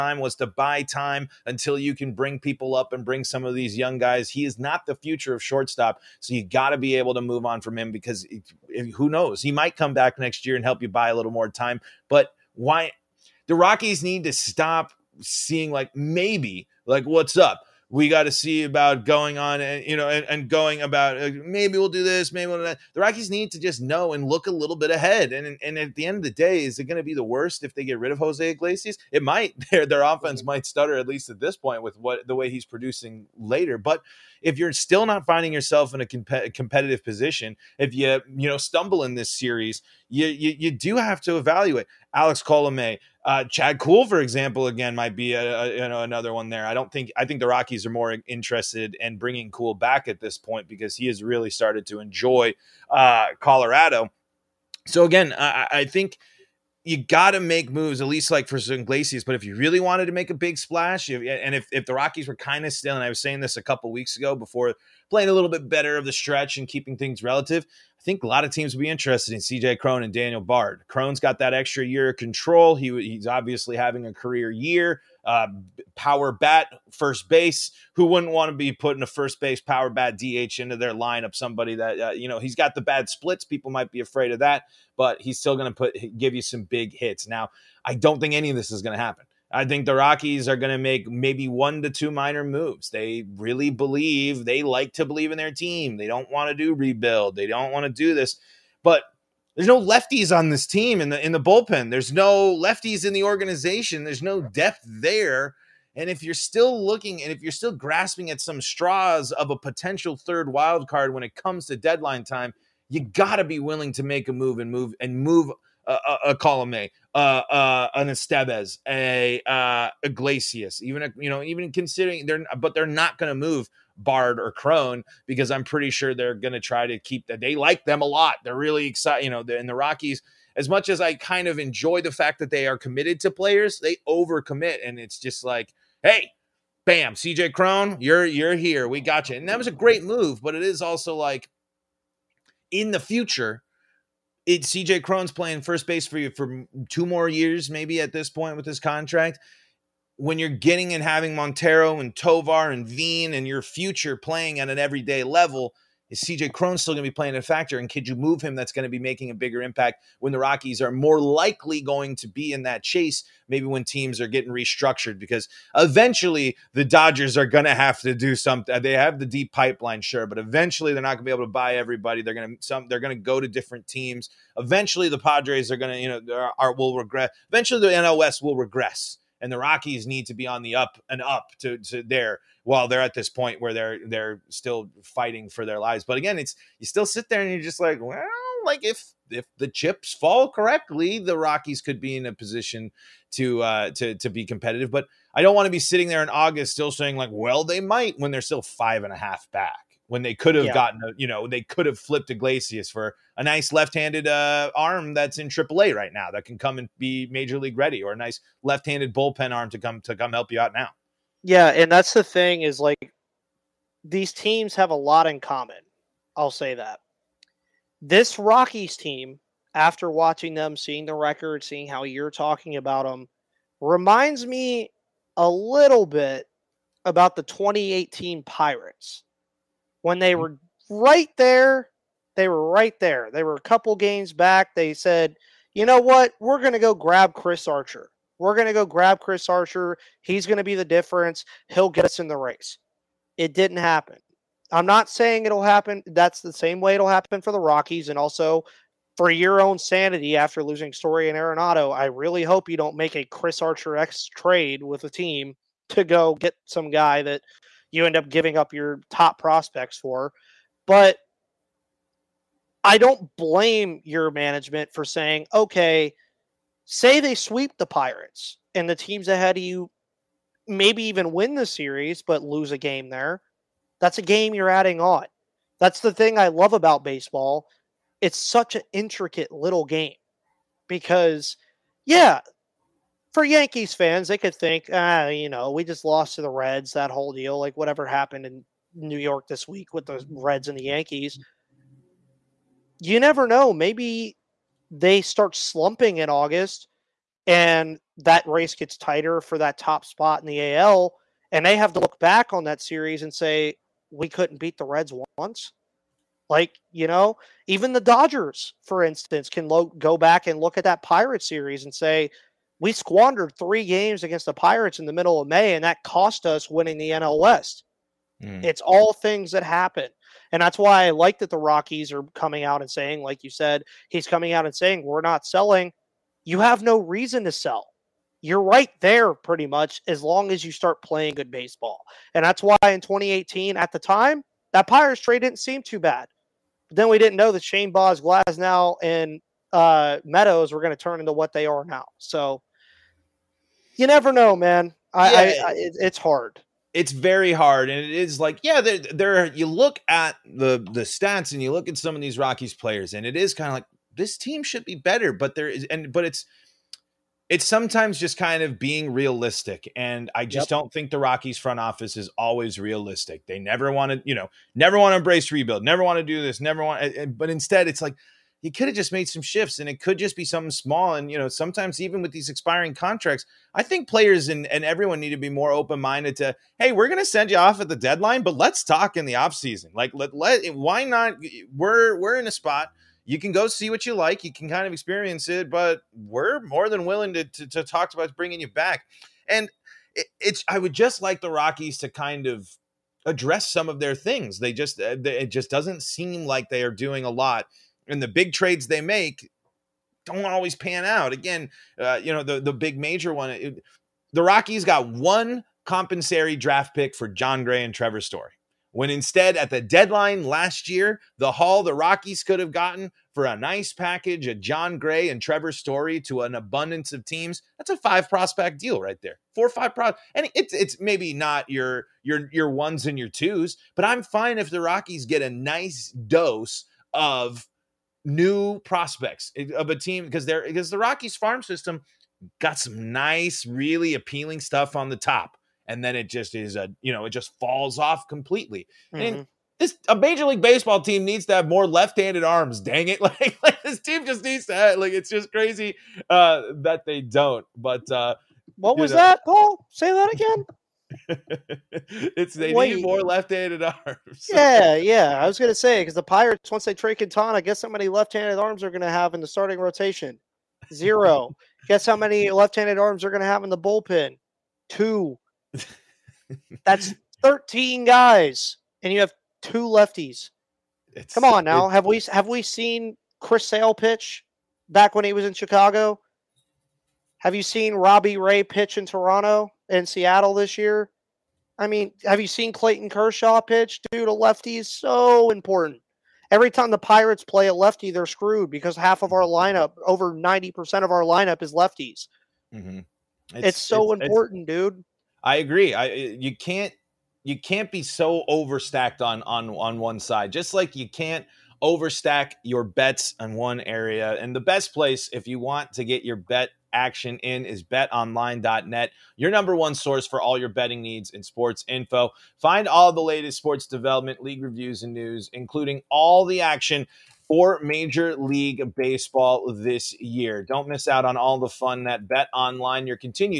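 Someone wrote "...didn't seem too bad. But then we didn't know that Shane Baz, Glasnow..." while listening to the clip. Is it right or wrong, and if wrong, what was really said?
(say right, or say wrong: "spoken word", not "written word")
right.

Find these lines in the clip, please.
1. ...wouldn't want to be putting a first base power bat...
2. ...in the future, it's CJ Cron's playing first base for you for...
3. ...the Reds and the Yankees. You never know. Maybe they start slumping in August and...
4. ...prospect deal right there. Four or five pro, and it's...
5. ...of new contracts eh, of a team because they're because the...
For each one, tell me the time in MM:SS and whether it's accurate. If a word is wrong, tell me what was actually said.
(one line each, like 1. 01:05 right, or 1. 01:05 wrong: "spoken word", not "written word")
1. 01:18 right
2. 02:22 right
3. 04:50 right
4. 06:58 right
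5. 07:07 wrong: "prospects", not "contracts".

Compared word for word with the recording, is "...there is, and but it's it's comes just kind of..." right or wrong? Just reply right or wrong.
wrong.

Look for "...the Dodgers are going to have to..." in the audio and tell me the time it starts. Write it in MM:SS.
02:46.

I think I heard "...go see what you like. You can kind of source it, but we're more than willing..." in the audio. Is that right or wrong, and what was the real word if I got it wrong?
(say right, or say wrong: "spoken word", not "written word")
wrong: "experience", not "source".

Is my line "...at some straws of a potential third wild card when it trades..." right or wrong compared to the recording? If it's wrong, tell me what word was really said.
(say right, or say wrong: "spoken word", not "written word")
wrong: "comes", not "trades".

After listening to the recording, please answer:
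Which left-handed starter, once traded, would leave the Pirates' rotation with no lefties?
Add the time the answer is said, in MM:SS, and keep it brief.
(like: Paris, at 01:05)
Quintana, at 07:37.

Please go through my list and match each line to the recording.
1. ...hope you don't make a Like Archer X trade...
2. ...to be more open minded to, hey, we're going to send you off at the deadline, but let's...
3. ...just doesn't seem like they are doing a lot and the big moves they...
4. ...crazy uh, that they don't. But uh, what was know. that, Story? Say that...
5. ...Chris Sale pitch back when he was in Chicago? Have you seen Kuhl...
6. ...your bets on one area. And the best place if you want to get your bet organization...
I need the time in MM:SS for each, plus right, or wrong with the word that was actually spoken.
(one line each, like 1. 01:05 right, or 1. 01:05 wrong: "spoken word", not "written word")
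1. 04:12 wrong: "Chris", not "Like"
2. 06:15 right
3. 06:35 wrong: "trades", not "moves"
4. 07:25 wrong: "Paul", not "Story"
5. 07:53 wrong: "Robbie", not "Kuhl"
6. 08:22 wrong: "action", not "organization".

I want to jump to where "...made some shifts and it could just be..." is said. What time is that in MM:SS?
06:09.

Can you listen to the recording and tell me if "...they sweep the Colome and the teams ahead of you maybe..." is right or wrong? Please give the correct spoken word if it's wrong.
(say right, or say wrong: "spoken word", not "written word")
wrong: "Pirates", not "Colome".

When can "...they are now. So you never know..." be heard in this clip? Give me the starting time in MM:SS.
05:41.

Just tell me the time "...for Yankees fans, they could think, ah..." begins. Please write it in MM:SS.
04:43.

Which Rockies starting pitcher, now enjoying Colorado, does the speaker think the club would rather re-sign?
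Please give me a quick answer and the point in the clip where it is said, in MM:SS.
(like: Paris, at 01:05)
Chad Kuhl, at 00:43.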